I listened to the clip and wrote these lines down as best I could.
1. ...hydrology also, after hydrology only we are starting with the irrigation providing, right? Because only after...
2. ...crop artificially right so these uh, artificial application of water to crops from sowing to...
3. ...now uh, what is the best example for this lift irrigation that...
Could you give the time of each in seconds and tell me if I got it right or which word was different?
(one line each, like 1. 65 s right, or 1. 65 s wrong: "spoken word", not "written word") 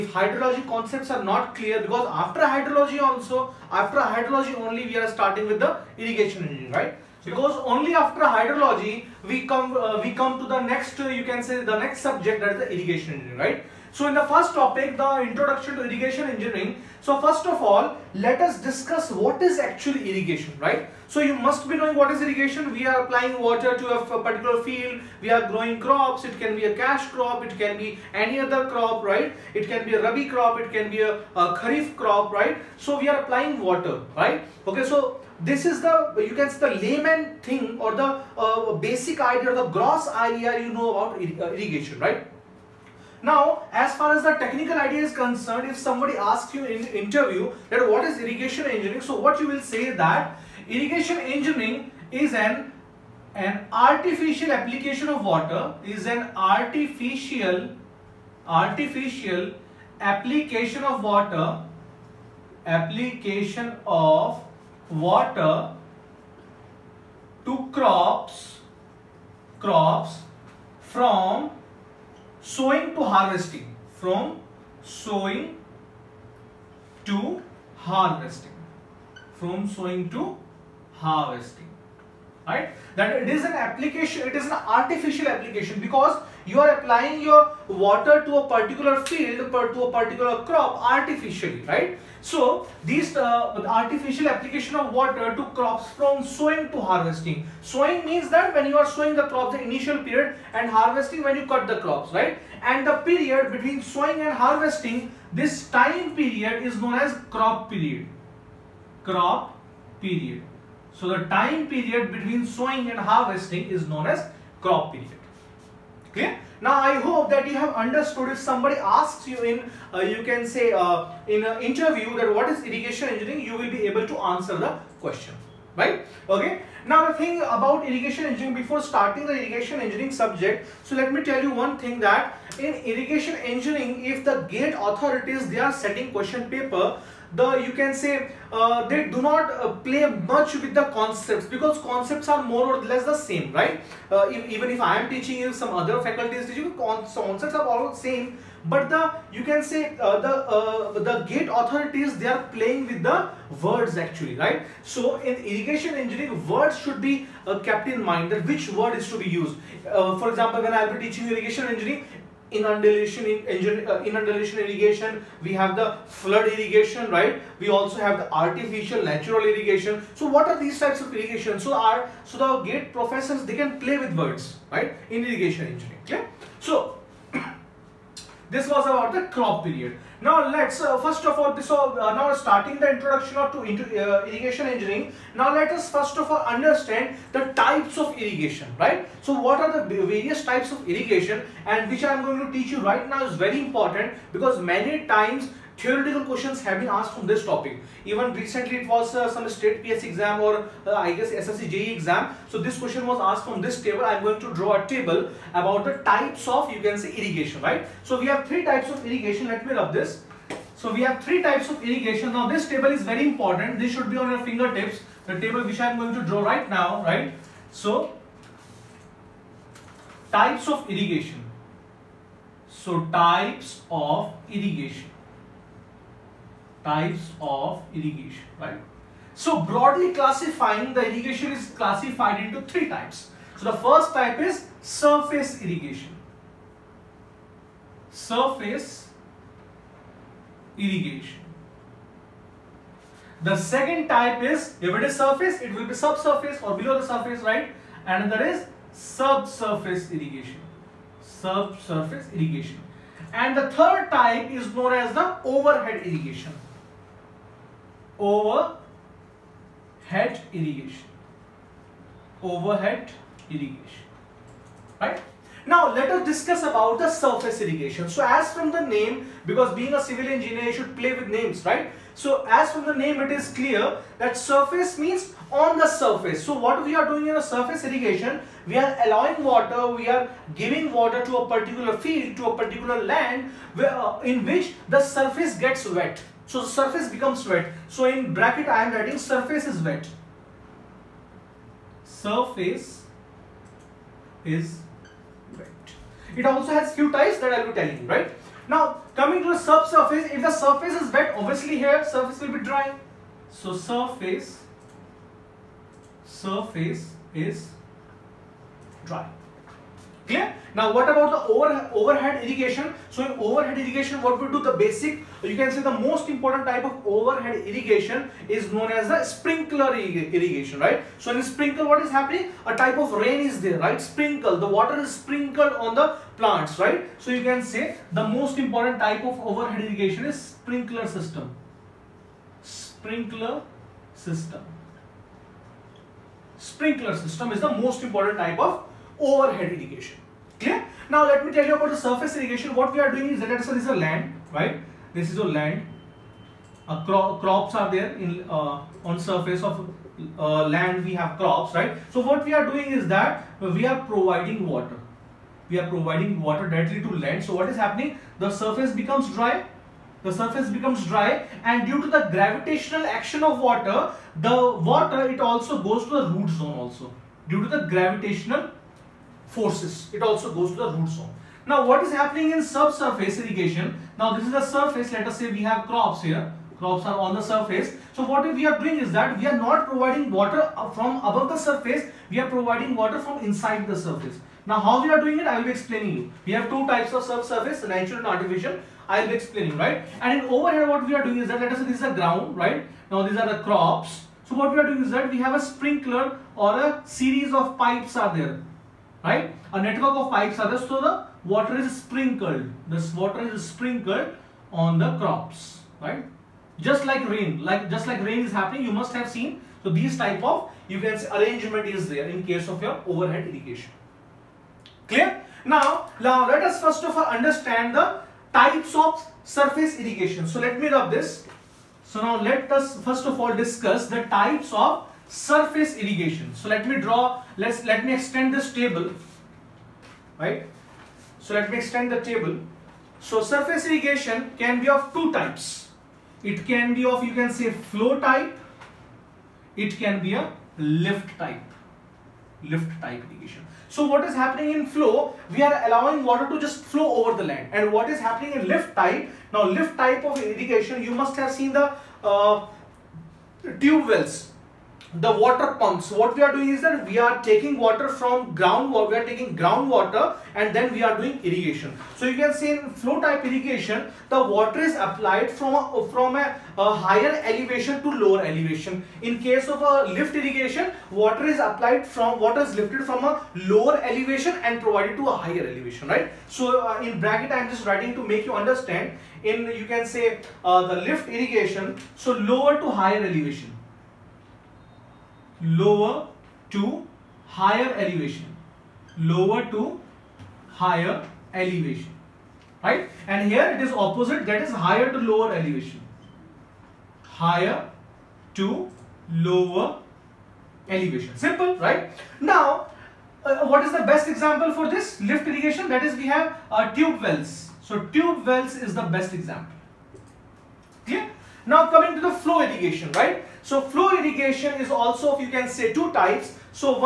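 1. 2 s wrong: "engineering", not "providing"
2. 90 s right
3. 502 s right.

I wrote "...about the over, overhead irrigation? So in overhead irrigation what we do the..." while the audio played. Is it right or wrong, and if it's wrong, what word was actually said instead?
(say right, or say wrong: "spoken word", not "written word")
right.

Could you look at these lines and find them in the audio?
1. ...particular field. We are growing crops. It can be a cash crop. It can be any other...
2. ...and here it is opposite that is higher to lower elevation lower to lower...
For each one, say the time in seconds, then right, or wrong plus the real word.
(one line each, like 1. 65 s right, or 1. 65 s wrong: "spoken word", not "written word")
1. 24 s right
2. 493 s wrong: "higher", not "lower".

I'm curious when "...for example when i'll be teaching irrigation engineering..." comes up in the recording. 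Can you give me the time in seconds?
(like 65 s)
159 s.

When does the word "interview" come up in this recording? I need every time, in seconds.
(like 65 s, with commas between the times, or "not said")
46 s, 121 s.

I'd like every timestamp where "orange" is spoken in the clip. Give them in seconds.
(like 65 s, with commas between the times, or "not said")
not said.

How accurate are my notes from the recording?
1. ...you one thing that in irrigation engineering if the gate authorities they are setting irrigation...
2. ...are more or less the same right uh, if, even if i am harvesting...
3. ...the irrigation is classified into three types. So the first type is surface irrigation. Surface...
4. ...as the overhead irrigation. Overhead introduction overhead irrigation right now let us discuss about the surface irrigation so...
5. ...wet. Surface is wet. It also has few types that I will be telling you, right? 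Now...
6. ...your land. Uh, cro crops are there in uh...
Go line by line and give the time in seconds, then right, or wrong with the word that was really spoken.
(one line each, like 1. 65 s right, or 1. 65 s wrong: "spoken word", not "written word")
1. 131 s wrong: "question", not "irrigation"
2. 142 s wrong: "teaching", not "harvesting"
3. 230 s right
4. 255 s wrong: "irrigation", not "introduction"
5. 289 s right
6. 345 s right.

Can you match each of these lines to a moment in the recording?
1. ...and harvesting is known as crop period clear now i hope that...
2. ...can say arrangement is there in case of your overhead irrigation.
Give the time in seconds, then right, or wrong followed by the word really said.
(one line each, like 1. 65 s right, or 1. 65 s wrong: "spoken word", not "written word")
1. 112 s right
2. 410 s right.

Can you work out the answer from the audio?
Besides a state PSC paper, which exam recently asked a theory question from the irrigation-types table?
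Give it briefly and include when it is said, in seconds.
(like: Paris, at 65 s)
SSC JE exam, at 201 s.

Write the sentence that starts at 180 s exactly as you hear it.
Now let's uh, first of all, so uh, now starting the introduction of to into, uh, irrigation engineering.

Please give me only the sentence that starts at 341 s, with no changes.
Now let me tell you about the surface irrigation.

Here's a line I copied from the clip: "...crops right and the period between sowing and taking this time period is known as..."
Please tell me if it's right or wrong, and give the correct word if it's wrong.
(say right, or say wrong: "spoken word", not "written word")
wrong: "harvesting", not "taking".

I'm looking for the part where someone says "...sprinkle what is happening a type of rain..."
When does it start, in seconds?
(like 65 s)
321 s.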